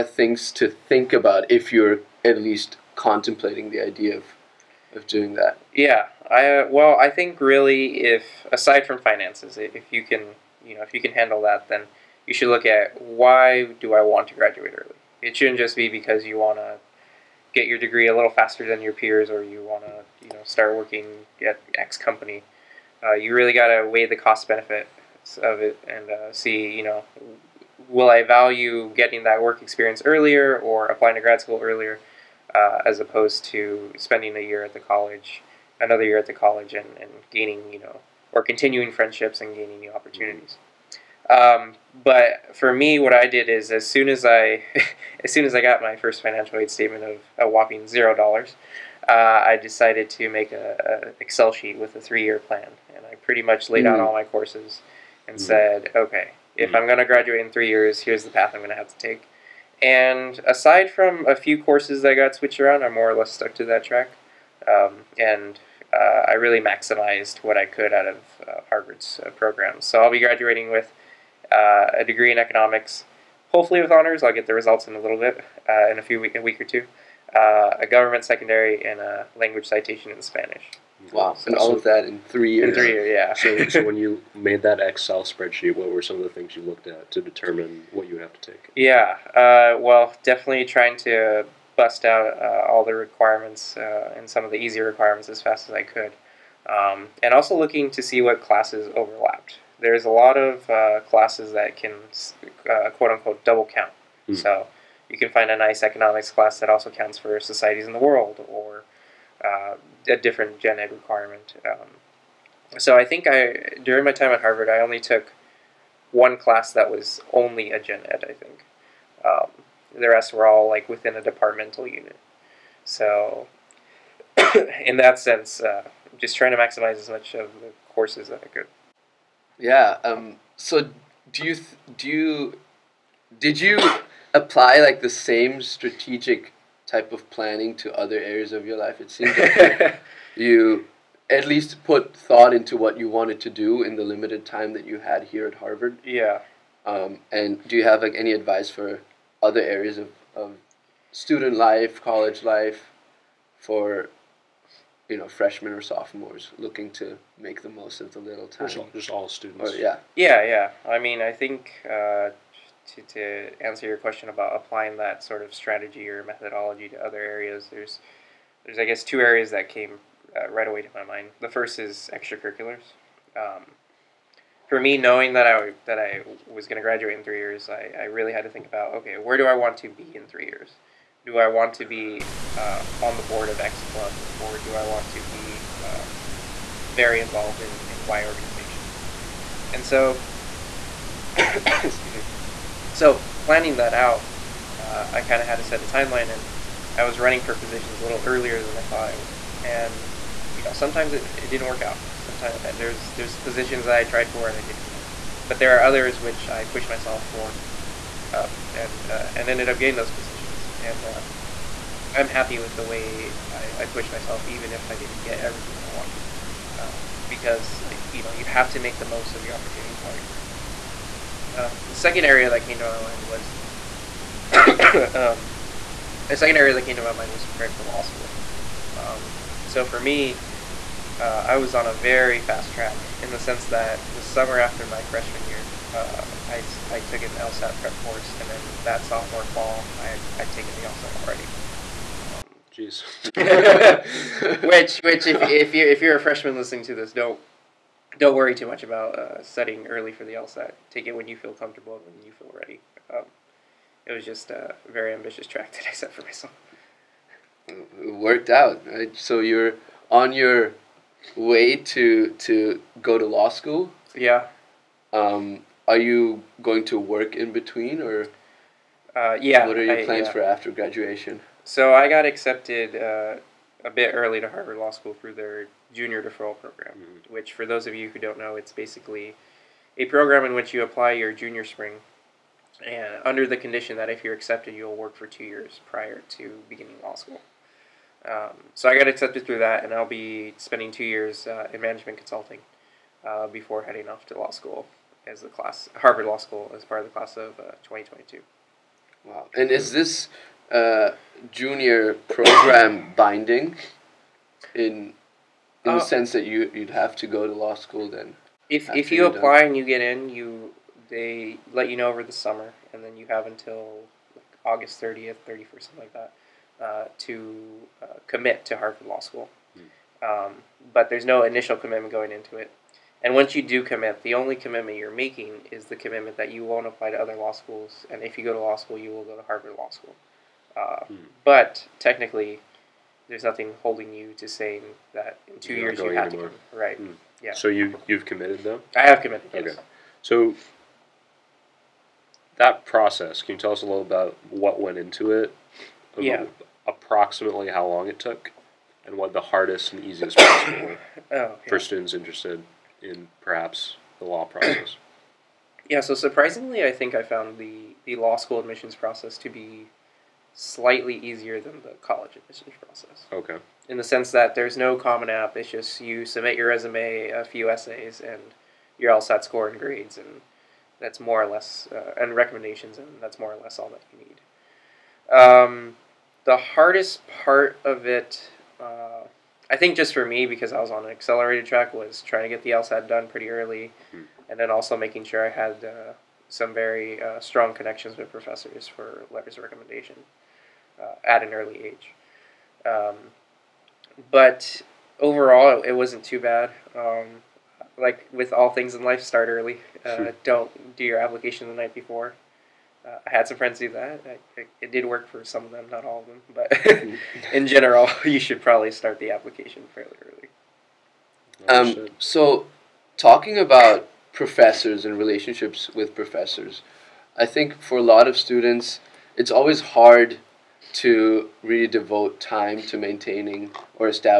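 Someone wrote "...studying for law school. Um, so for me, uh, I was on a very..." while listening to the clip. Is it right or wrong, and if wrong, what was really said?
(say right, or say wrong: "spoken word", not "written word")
wrong: "preparing", not "studying".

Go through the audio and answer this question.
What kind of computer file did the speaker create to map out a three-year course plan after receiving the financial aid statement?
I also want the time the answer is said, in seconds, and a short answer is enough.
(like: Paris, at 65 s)
Excel sheet, at 51 s.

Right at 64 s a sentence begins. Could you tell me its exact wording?
Um, and uh, I really maximized what I could out of uh, Harvard's uh, program.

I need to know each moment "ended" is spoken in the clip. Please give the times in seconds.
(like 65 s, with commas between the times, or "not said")
209 s.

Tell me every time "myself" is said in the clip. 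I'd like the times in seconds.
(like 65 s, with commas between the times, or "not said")
206 s, 214 s, 256 s.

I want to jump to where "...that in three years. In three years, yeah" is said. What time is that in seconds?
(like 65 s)
81 s.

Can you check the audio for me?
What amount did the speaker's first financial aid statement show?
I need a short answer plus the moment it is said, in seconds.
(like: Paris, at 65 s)
0 dollars, at 47 s.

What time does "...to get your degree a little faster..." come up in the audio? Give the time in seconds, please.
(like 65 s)
16 s.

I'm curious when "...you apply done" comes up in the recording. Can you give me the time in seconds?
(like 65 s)
309 s.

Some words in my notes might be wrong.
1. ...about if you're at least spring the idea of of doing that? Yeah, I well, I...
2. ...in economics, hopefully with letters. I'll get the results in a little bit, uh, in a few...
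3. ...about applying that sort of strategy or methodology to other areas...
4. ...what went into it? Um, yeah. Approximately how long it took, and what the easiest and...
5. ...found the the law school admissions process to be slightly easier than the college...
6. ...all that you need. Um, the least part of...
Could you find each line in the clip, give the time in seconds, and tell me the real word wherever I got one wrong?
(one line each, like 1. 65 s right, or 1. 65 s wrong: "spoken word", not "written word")
1. 1 s wrong: "contemplating", not "spring"
2. 72 s wrong: "honors", not "letters"
3. 164 s right
4. 344 s wrong: "hardest", not "easiest"
5. 357 s right
6. 373 s wrong: "hardest", not "least".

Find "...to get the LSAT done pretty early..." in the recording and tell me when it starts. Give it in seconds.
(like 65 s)
382 s.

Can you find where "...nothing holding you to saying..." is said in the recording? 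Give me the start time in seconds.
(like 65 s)
333 s.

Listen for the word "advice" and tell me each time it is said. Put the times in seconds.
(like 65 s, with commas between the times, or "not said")
148 s.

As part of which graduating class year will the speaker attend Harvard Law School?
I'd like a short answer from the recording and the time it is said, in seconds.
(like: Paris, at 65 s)
2022, at 297 s.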